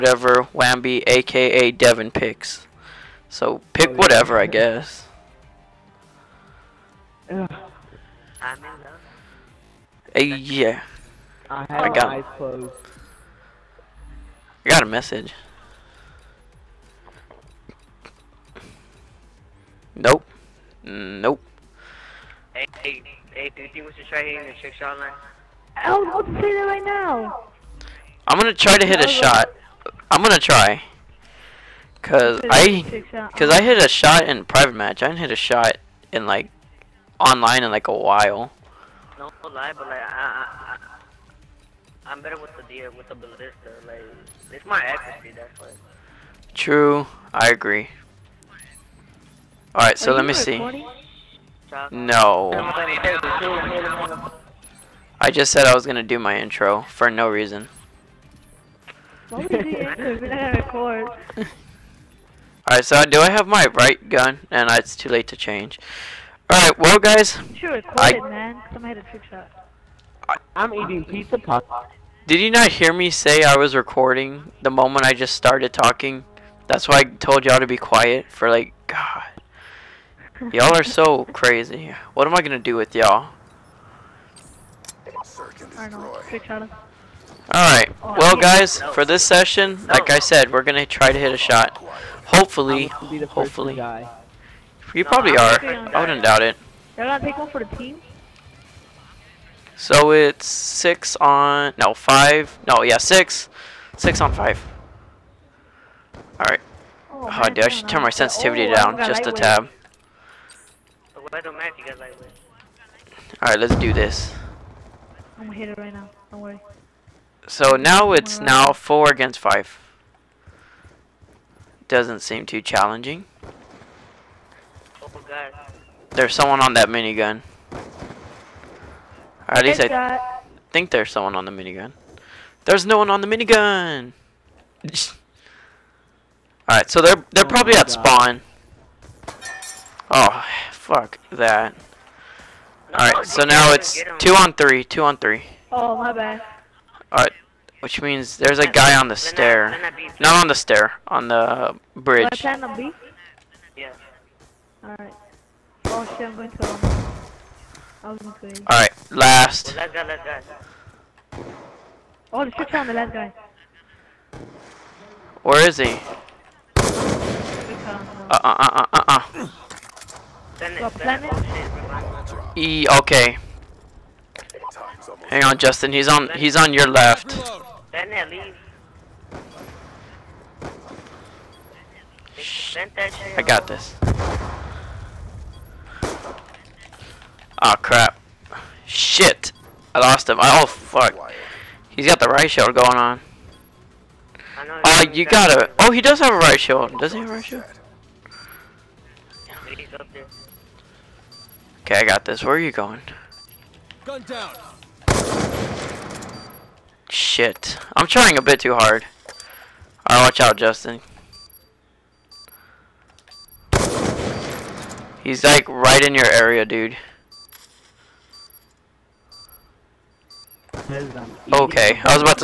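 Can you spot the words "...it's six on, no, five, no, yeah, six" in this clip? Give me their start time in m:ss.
1:40.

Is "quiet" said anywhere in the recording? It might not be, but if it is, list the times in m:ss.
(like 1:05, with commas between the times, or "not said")
1:17.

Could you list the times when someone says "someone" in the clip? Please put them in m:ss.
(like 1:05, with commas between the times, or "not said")
2:06, 2:11.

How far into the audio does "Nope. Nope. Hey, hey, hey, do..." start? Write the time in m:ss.
0:19.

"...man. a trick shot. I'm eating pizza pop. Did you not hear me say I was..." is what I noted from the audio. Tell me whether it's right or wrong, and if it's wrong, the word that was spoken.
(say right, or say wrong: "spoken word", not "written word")
right.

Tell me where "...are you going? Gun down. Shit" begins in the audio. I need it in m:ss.
3:22.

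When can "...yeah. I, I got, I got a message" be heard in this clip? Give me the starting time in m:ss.
0:10.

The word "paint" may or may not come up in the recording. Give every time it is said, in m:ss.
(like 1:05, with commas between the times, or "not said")
not said.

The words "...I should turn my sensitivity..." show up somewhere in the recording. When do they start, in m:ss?
1:47.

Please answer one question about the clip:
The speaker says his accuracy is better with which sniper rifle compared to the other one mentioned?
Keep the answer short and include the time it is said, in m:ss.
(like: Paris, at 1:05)
Ballista, at 0:43.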